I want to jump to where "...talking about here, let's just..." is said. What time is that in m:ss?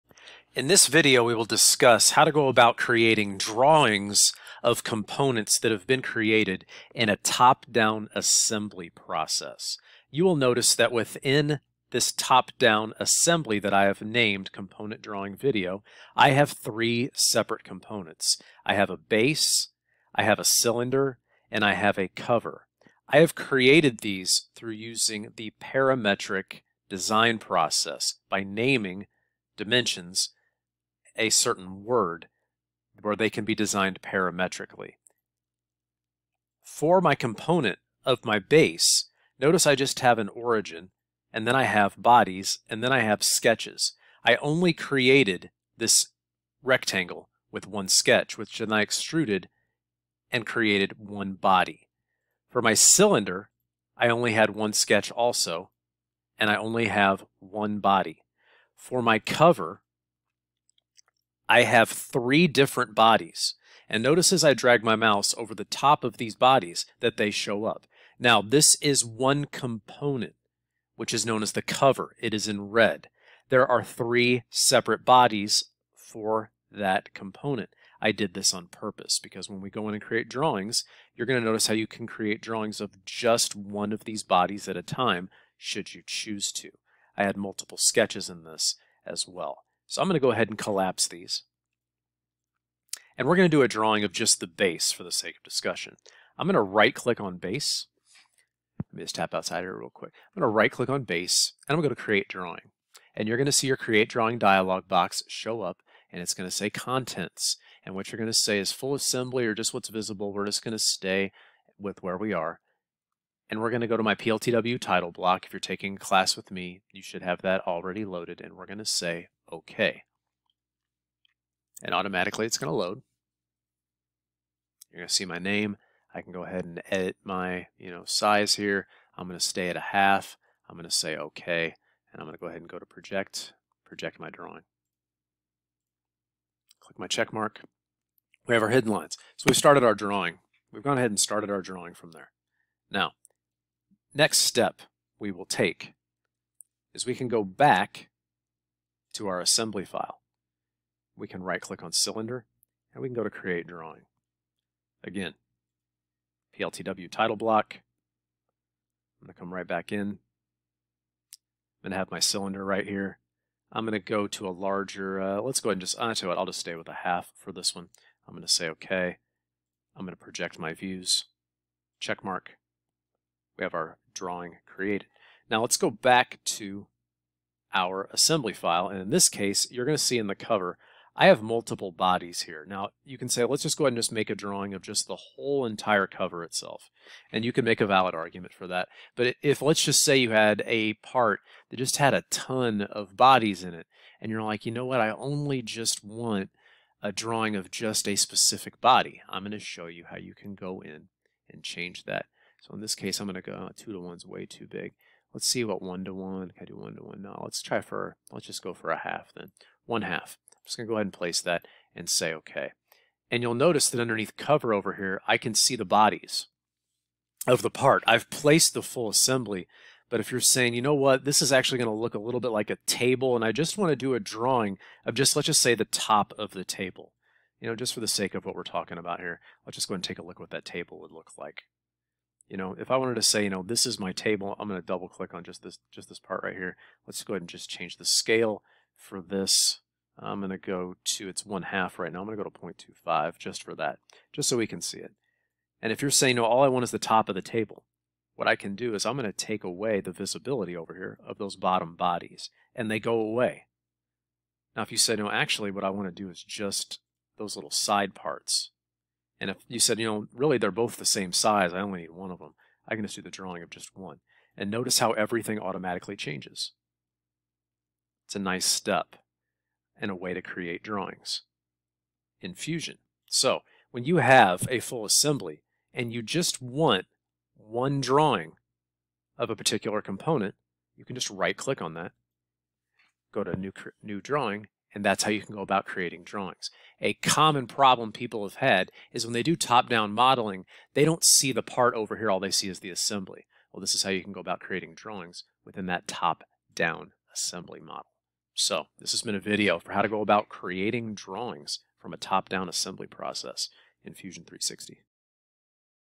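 3:48.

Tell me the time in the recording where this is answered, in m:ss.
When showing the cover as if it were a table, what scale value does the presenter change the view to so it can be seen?
4:02.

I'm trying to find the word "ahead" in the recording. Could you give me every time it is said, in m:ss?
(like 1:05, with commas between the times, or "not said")
1:30, 2:06, 2:12, 2:20, 2:45, 3:03, 3:30, 3:57.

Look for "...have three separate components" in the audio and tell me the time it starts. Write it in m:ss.
0:16.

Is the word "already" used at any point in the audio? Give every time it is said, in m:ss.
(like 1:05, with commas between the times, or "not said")
1:57.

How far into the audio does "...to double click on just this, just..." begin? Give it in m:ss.
3:54.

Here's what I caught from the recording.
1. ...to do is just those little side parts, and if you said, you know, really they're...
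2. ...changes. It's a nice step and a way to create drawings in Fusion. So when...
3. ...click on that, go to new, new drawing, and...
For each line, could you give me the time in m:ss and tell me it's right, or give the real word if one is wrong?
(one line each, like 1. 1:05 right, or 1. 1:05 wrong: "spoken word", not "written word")
1. 4:16 right
2. 4:26 right
3. 4:41 right.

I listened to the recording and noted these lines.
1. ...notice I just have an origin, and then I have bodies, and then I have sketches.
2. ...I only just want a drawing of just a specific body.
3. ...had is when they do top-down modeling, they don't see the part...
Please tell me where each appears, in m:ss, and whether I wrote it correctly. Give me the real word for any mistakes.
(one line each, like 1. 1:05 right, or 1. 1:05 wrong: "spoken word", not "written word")
1. 0:39 right
2. 3:15 right
3. 4:48 right.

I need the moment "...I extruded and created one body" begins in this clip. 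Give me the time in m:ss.
0:48.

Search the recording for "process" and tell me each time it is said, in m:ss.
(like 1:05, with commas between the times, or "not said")
0:08, 0:27, 5:03.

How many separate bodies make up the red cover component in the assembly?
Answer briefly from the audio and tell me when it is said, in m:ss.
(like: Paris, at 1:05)
3, at 1:01.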